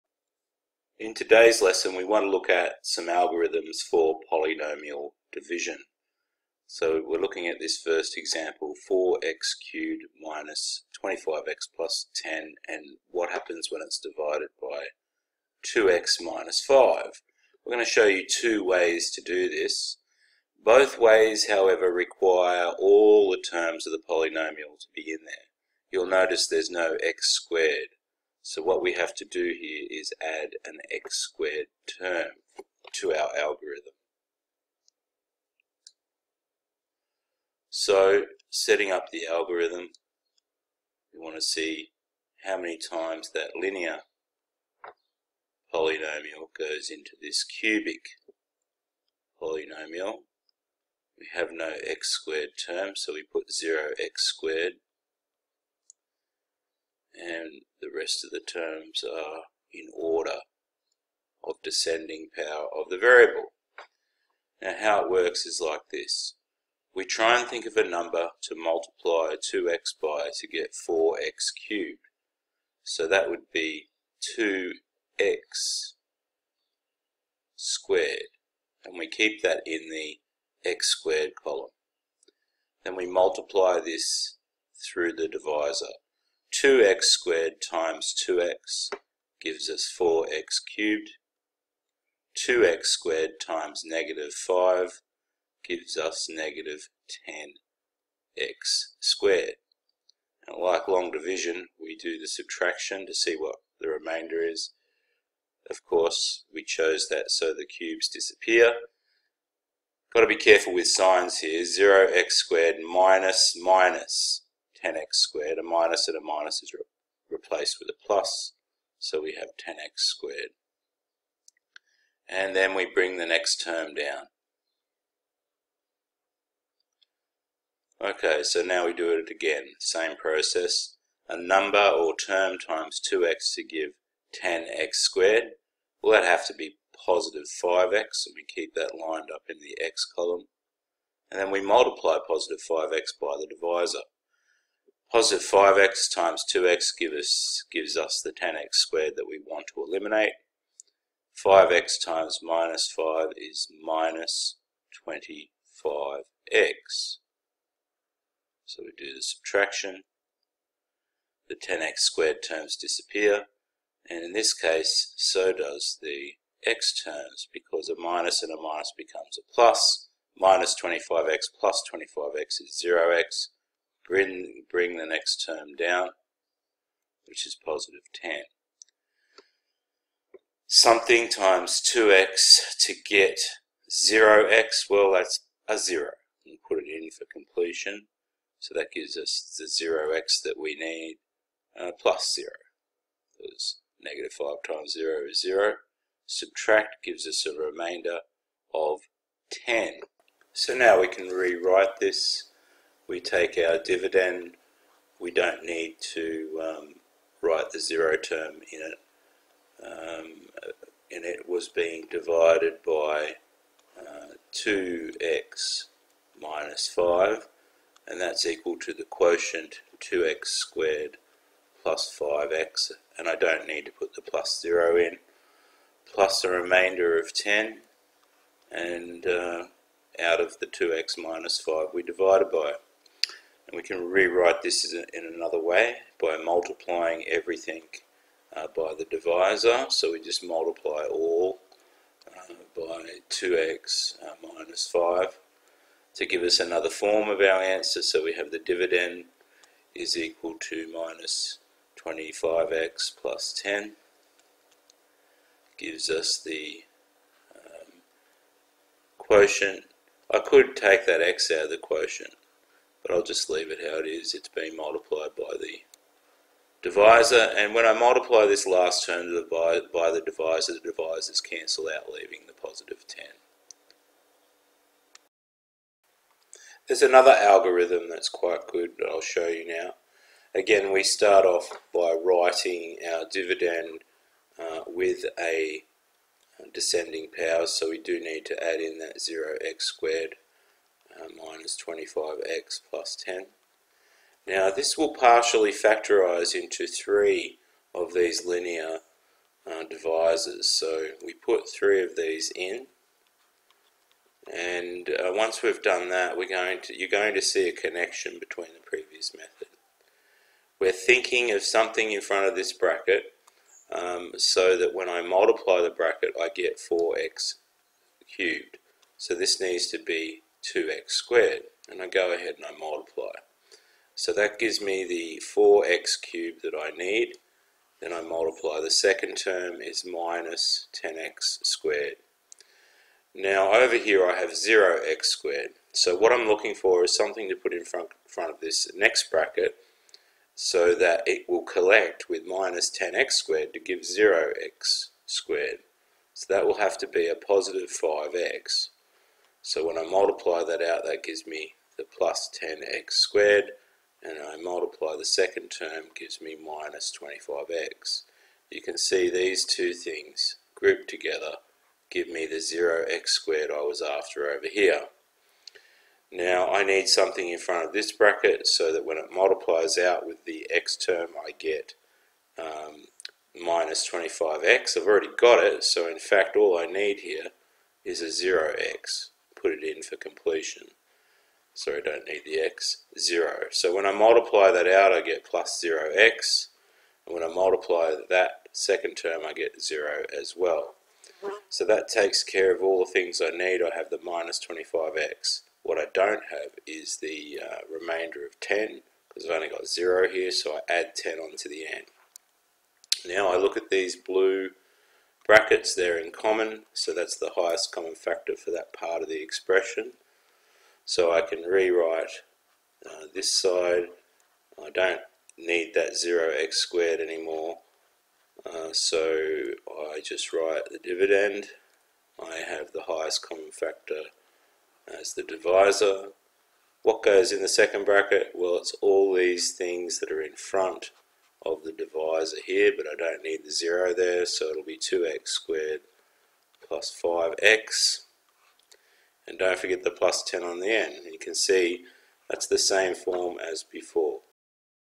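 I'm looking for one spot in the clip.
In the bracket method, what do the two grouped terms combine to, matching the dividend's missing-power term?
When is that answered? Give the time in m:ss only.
6:02.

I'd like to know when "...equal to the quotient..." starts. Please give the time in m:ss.
3:38.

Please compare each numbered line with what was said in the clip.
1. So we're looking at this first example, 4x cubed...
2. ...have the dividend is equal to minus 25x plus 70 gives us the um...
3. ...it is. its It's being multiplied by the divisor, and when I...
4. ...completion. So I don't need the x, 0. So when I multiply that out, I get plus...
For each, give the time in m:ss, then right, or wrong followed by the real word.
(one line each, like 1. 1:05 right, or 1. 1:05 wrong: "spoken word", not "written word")
1. 0:06 right
2. 4:08 wrong: "10", not "70"
3. 4:23 right
4. 6:20 right.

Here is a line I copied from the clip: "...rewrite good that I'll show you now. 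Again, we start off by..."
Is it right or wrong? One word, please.
wrong.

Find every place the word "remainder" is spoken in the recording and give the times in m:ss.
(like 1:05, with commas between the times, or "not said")
1:43, 3:17, 3:46, 6:37.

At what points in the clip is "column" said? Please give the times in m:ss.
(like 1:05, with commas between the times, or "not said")
1:21, 2:20.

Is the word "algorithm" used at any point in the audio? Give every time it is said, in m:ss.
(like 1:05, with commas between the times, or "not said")
0:03, 0:33, 0:39, 4:37.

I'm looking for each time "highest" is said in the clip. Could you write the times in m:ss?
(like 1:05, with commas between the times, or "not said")
6:47, 7:03.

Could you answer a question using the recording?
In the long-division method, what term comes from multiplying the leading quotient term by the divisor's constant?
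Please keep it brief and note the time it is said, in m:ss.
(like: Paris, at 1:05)
-10x squared, at 1:36.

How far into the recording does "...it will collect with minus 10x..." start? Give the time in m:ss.
5:41.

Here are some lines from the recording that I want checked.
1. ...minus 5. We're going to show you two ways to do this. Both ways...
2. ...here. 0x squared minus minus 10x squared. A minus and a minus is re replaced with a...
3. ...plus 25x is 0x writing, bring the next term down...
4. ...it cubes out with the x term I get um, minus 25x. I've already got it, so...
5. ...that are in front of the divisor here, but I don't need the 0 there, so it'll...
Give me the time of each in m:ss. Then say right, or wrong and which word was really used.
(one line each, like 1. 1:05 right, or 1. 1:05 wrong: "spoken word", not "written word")
1. 0:16 right
2. 1:51 right
3. 2:51 wrong: "bring", not "writing"
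4. 6:09 wrong: "multiplies", not "cubes"
5. 7:10 right.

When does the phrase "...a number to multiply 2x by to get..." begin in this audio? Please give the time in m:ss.
1:07.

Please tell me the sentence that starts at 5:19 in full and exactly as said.
So this needs to be 2x squared and I go ahead and I multiply.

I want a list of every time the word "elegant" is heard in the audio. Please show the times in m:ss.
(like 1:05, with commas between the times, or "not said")
not said.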